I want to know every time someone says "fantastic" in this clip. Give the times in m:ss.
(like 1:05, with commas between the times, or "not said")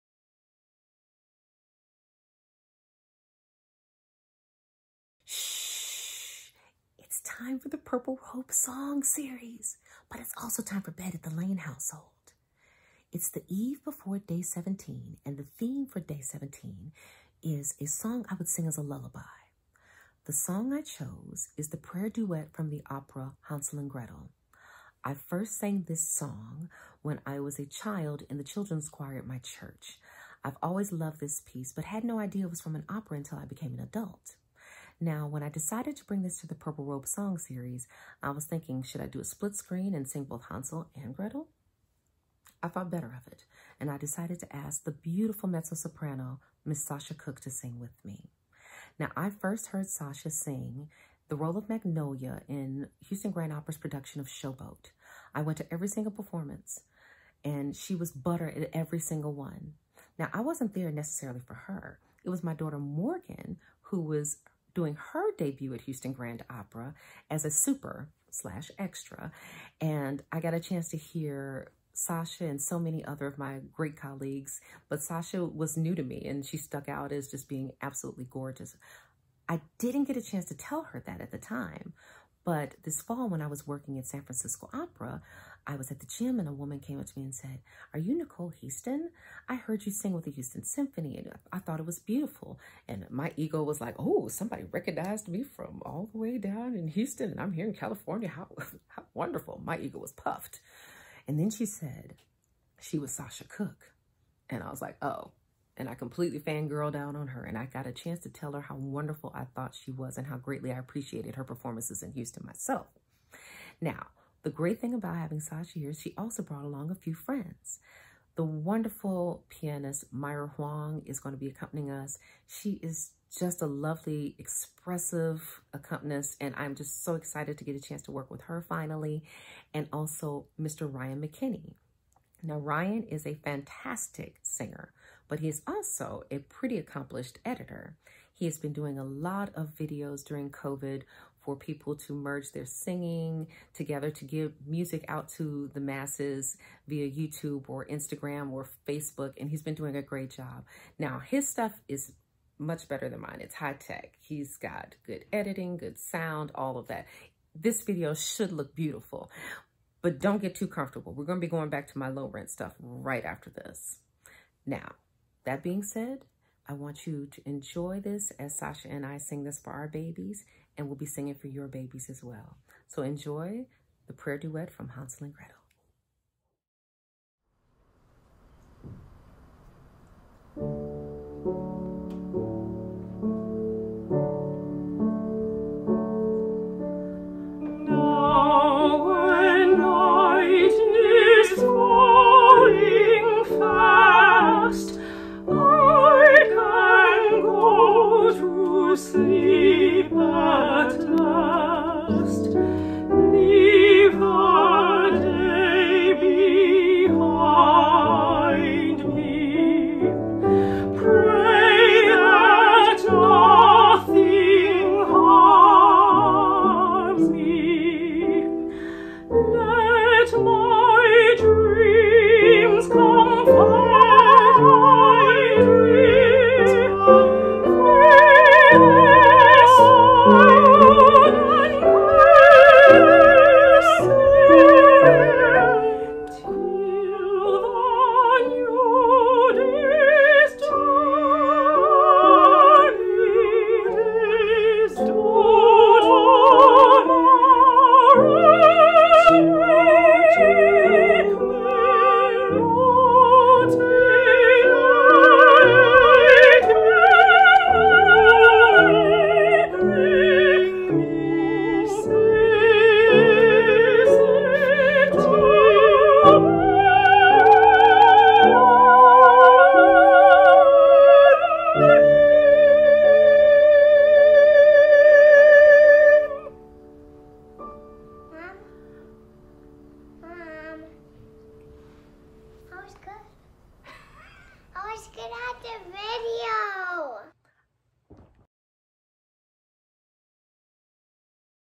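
2:13.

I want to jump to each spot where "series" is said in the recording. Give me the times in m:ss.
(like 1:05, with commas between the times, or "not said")
0:09, 0:37.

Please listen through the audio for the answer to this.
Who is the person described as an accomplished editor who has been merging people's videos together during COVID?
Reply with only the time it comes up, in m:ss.
2:10.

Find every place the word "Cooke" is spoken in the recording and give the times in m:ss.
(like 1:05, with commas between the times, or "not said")
0:47, 1:43.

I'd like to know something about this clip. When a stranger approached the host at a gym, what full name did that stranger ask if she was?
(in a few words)
Nicole Heaston.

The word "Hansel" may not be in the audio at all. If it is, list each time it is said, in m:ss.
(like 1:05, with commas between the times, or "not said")
0:23, 0:40, 2:54.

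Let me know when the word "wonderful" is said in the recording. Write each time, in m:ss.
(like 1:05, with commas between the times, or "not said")
1:39, 1:48, 1:58.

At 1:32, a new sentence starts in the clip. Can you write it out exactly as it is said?
And my ego was like, Oh, somebody recognized me from all the way down in Houston and I'm here in California.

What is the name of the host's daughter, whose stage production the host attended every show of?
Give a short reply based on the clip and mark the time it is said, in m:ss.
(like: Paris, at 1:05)
Morgan, at 1:02.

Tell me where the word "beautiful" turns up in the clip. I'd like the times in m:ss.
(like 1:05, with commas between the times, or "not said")
0:44, 1:31, 2:38.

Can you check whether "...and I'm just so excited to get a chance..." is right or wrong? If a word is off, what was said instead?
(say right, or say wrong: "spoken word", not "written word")
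right.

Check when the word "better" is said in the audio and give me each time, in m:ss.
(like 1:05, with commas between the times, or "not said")
0:42, 2:32.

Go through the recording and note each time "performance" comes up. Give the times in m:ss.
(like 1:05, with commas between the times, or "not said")
0:56, 1:51.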